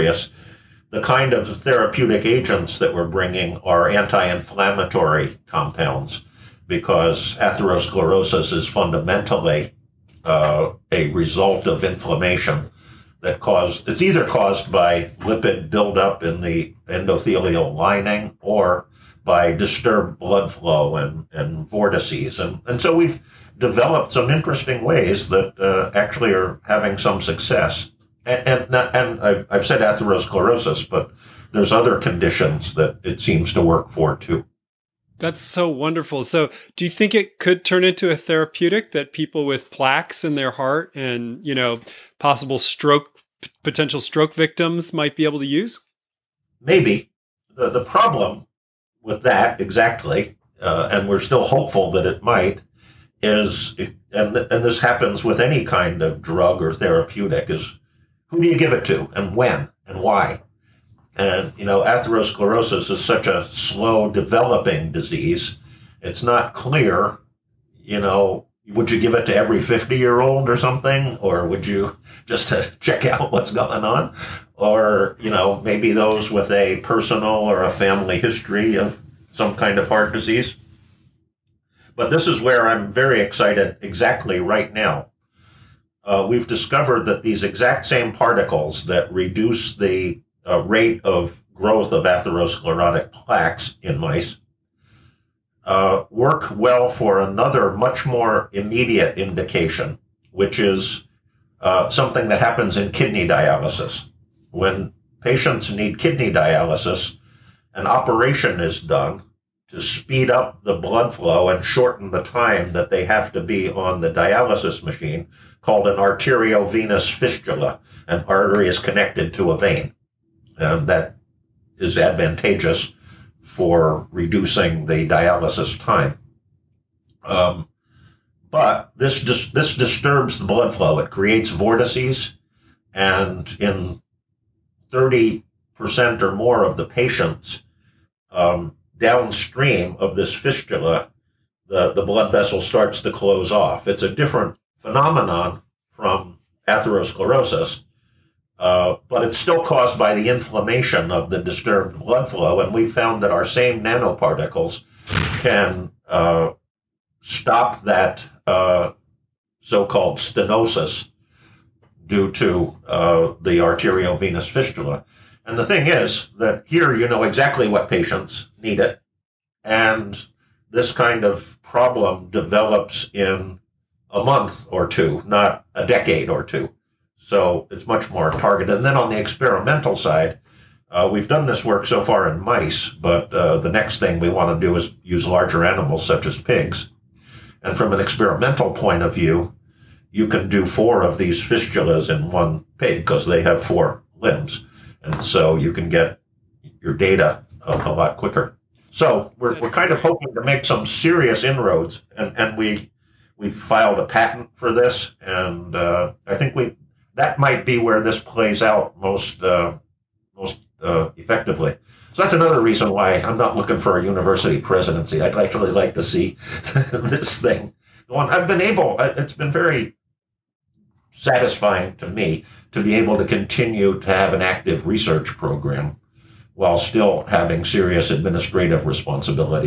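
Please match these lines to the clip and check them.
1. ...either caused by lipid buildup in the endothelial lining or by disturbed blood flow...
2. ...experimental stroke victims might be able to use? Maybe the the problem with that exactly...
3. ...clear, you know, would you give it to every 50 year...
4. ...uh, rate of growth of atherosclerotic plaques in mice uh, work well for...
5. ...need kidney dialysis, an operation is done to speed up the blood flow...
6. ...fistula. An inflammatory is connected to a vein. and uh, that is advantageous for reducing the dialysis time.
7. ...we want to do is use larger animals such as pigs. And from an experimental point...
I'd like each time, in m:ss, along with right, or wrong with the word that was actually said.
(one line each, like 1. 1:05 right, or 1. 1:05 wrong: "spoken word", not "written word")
1. 0:14 right
2. 0:43 wrong: "potential", not "experimental"
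3. 1:06 right
4. 1:30 right
5. 1:45 right
6. 1:57 wrong: "artery", not "inflammatory"
7. 3:04 right.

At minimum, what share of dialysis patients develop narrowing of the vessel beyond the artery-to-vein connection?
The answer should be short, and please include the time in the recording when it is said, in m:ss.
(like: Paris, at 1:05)
30%, at 2:14.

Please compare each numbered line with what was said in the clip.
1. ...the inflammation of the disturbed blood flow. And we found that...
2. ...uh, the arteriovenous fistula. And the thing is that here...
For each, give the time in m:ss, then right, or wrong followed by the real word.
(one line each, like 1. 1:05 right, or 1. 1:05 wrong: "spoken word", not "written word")
1. 2:30 right
2. 2:42 right.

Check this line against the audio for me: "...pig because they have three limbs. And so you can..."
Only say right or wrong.
wrong.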